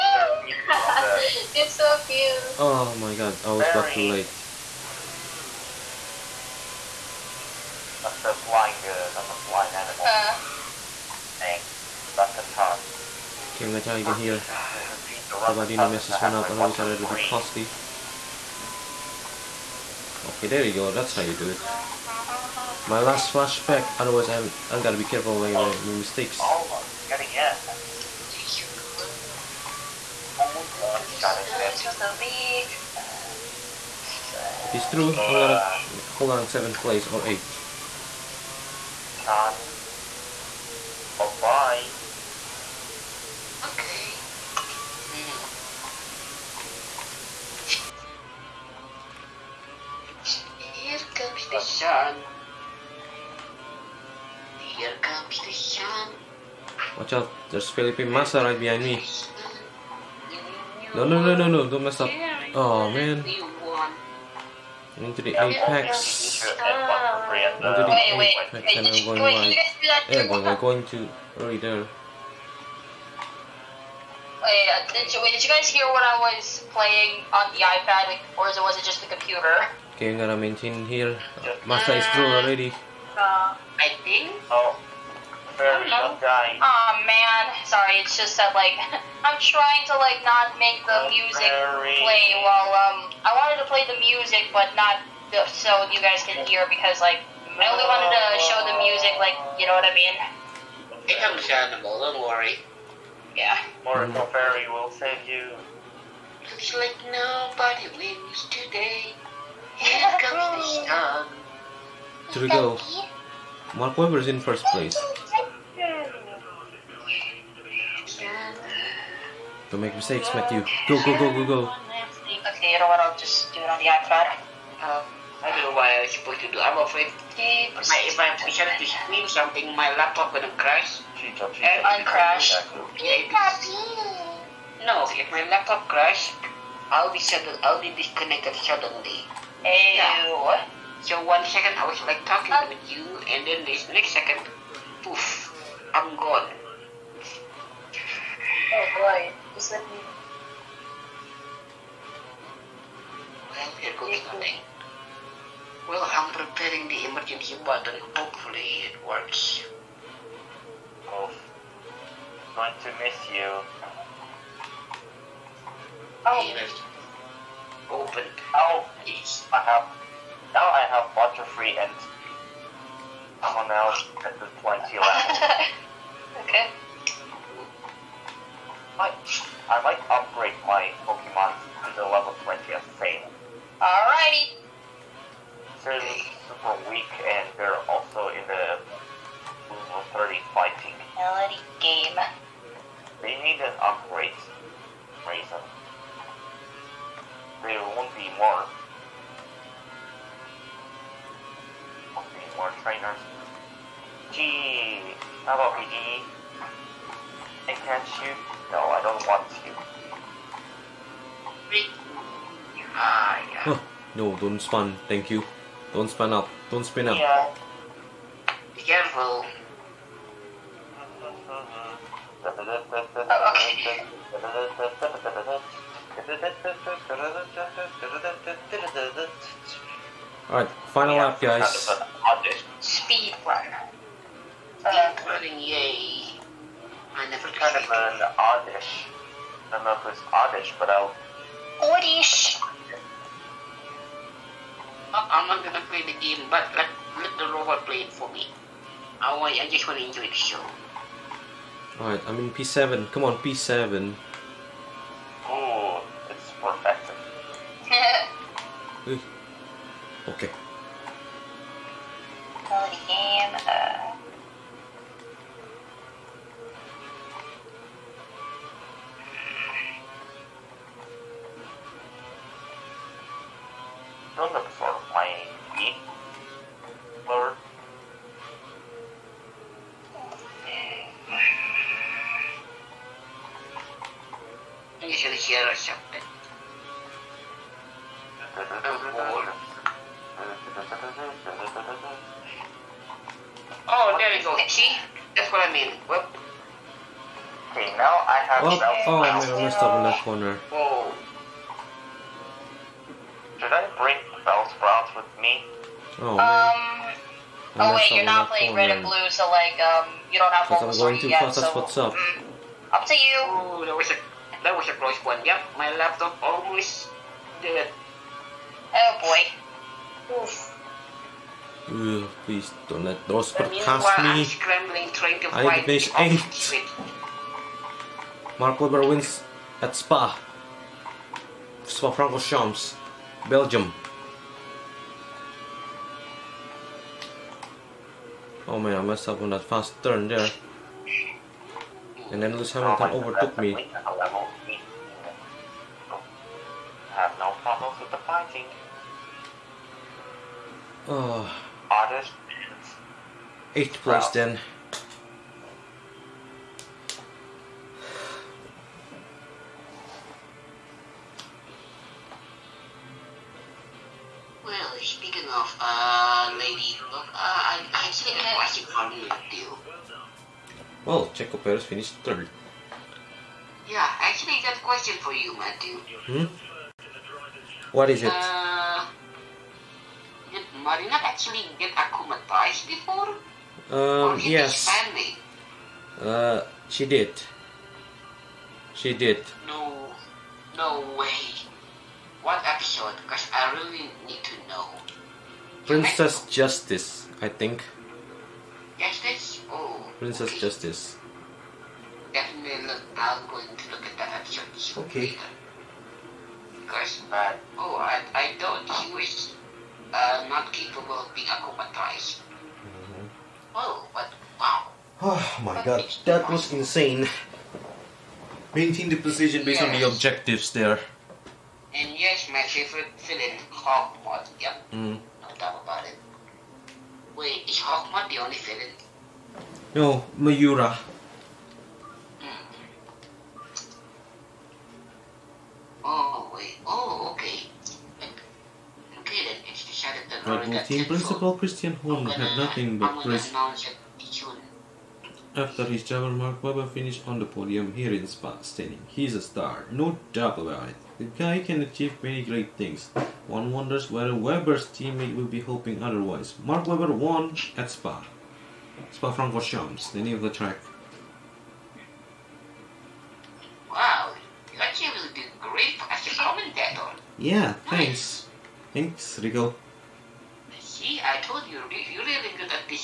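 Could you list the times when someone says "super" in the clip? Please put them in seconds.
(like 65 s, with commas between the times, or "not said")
186 s.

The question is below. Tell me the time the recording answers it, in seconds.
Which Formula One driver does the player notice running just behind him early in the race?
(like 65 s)
57 s.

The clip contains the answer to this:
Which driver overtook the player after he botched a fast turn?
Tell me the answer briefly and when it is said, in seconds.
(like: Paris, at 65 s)
Lewis Hamilton, at 342 s.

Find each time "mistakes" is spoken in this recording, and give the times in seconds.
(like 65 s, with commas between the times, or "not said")
25 s, 119 s.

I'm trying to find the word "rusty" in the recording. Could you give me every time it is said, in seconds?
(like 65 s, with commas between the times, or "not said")
17 s.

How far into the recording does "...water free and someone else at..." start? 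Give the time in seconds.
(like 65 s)
171 s.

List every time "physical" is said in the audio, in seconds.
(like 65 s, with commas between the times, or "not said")
not said.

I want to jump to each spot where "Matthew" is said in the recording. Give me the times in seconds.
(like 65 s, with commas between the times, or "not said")
120 s, 375 s.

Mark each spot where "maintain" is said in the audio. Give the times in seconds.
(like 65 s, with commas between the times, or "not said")
80 s, 418 s.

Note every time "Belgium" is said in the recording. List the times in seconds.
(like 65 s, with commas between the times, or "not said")
333 s.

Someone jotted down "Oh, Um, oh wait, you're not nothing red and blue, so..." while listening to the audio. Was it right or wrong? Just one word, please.
wrong.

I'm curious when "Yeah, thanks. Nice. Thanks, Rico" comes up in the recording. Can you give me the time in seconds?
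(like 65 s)
467 s.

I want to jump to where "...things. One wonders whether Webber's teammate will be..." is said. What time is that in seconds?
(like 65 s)
452 s.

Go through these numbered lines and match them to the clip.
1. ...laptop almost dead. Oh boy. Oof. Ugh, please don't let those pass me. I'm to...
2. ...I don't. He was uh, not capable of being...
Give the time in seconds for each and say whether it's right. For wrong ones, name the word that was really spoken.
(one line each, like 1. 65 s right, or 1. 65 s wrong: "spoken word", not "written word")
1. 315 s right
2. 408 s right.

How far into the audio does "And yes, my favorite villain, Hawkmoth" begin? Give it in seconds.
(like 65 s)
421 s.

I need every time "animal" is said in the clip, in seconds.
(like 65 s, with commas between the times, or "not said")
9 s, 101 s.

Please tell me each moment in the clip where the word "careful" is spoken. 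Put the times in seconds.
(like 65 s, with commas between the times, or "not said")
25 s, 218 s.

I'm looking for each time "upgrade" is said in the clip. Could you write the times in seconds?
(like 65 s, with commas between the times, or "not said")
180 s, 193 s.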